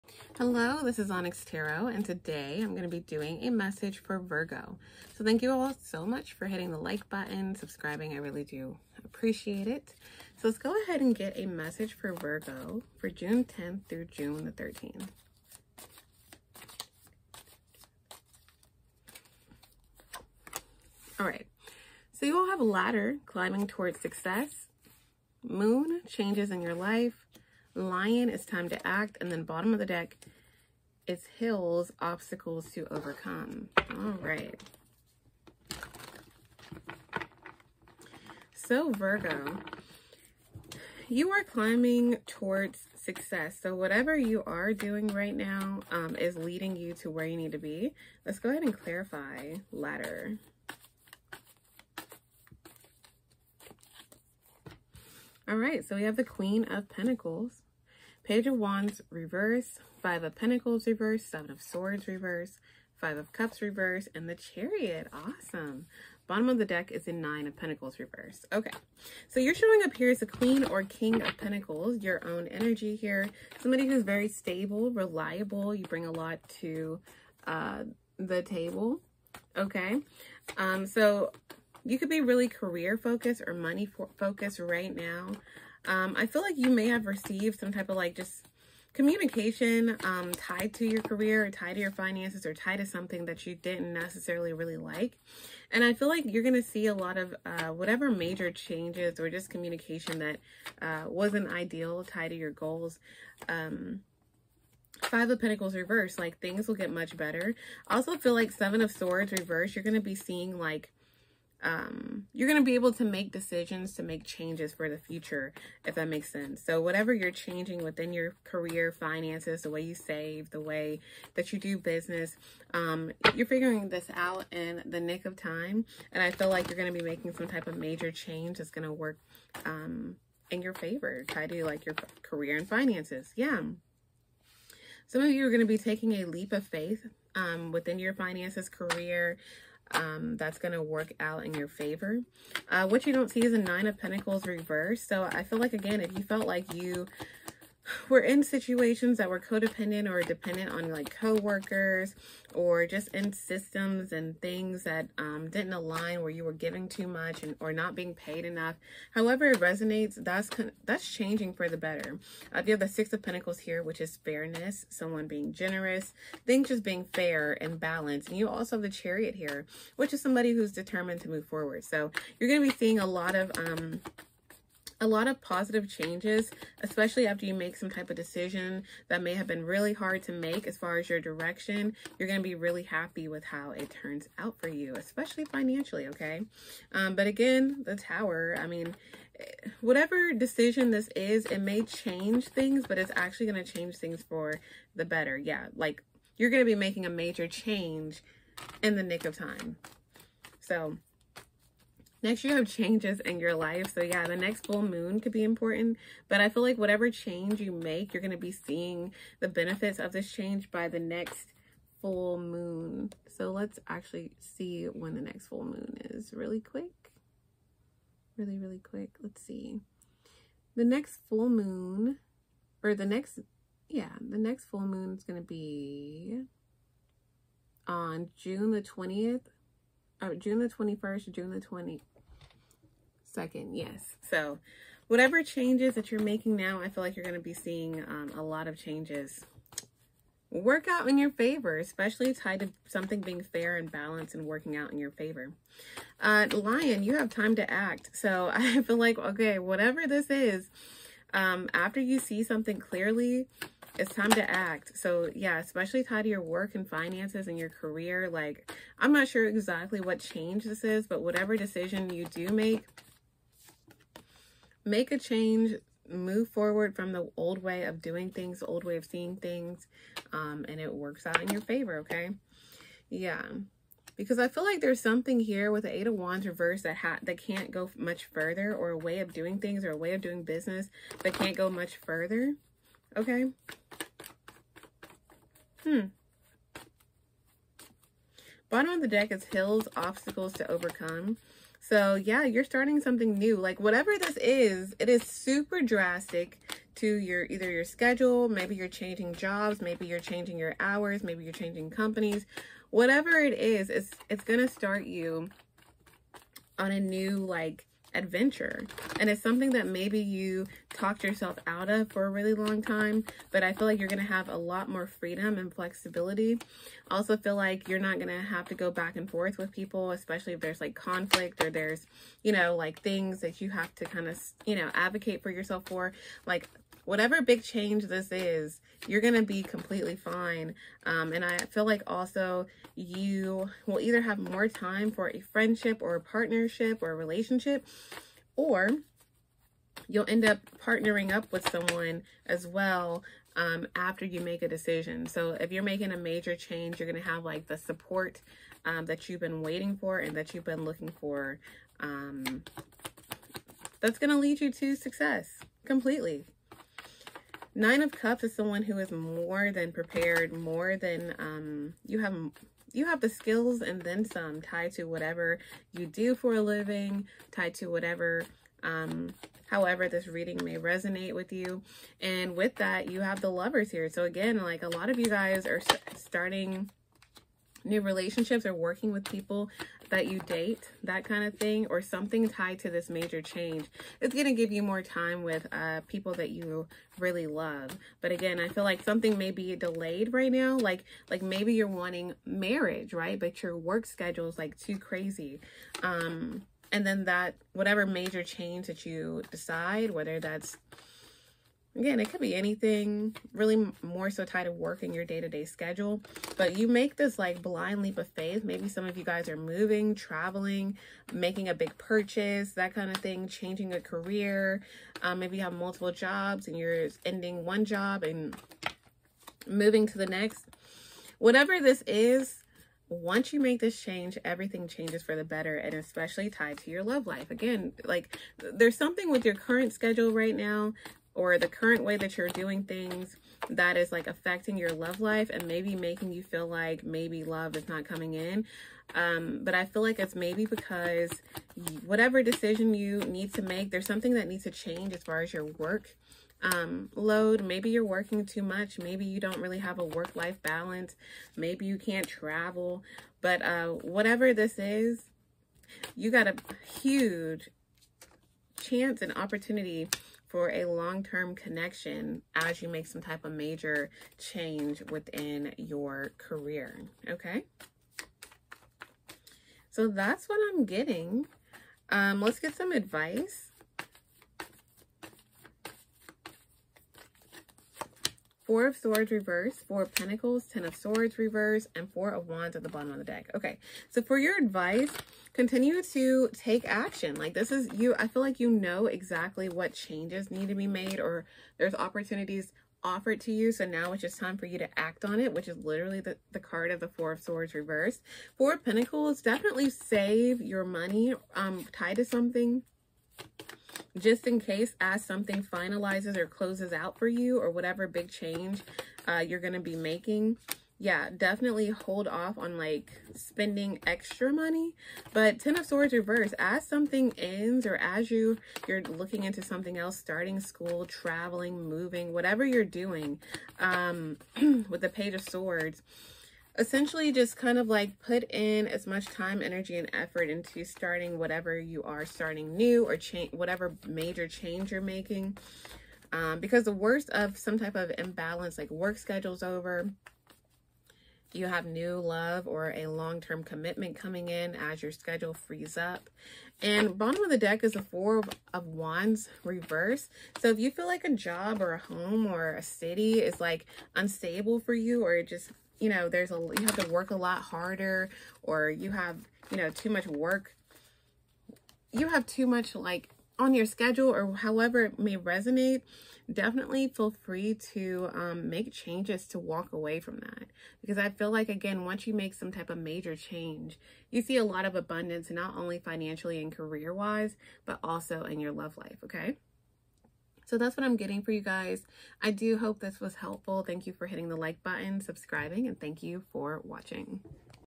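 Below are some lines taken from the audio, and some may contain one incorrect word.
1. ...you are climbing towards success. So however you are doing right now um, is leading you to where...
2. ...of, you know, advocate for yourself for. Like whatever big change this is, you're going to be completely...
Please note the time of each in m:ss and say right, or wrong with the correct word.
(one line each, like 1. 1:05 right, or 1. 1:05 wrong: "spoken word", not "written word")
1. 0:41 wrong: "whatever", not "however"
2. 5:24 right.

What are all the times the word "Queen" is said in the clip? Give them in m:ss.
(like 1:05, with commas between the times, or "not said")
0:56, 1:10.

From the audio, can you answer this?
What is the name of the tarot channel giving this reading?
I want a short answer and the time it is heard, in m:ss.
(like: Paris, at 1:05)
Onyx Tarot, at 0:01.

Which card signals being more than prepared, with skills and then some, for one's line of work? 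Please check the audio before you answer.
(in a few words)
Nine of Cups.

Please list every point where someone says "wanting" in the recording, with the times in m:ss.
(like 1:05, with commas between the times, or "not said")
6:31.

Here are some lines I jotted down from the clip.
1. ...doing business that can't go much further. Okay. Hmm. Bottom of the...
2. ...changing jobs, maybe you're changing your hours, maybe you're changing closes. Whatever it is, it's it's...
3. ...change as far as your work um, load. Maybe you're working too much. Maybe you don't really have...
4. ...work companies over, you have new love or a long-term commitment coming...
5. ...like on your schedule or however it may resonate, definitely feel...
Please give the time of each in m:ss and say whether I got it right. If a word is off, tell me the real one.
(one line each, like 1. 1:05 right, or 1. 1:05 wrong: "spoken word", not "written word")
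1. 4:40 right
2. 4:58 wrong: "companies", not "closes"
3. 7:24 right
4. 8:58 wrong: "schedules", not "companies"
5. 9:22 right.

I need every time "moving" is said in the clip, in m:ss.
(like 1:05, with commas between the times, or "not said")
6:49, 6:59, 8:41.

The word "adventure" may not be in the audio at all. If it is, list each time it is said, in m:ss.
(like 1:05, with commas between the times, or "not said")
5:08.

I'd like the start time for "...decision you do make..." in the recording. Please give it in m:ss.
4:21.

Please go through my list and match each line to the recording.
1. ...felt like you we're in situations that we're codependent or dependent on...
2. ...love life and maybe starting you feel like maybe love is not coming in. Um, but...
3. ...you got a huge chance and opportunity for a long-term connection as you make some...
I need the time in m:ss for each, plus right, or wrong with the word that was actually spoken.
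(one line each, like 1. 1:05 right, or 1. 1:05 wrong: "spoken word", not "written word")
1. 2:26 right
2. 7:14 wrong: "making", not "starting"
3. 7:36 right.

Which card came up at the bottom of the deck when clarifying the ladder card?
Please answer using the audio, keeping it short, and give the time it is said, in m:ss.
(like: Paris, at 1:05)
Nine of Pentacles reversed, at 1:07.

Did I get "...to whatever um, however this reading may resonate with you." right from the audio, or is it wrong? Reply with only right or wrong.
right.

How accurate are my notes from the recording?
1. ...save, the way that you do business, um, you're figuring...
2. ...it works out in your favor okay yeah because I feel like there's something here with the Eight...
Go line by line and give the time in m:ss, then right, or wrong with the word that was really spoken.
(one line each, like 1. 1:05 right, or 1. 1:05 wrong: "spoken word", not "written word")
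1. 1:59 right
2. 4:30 right.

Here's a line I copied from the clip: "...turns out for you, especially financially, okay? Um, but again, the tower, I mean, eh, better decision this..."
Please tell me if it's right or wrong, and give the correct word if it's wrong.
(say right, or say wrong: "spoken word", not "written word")
wrong: "whatever", not "better".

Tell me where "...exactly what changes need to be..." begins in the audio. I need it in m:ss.
8:09.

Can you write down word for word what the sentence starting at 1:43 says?
Um, Five of Pentacles reverse, like things will get much better.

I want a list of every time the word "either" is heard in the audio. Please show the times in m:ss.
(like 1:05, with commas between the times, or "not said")
4:57, 5:33.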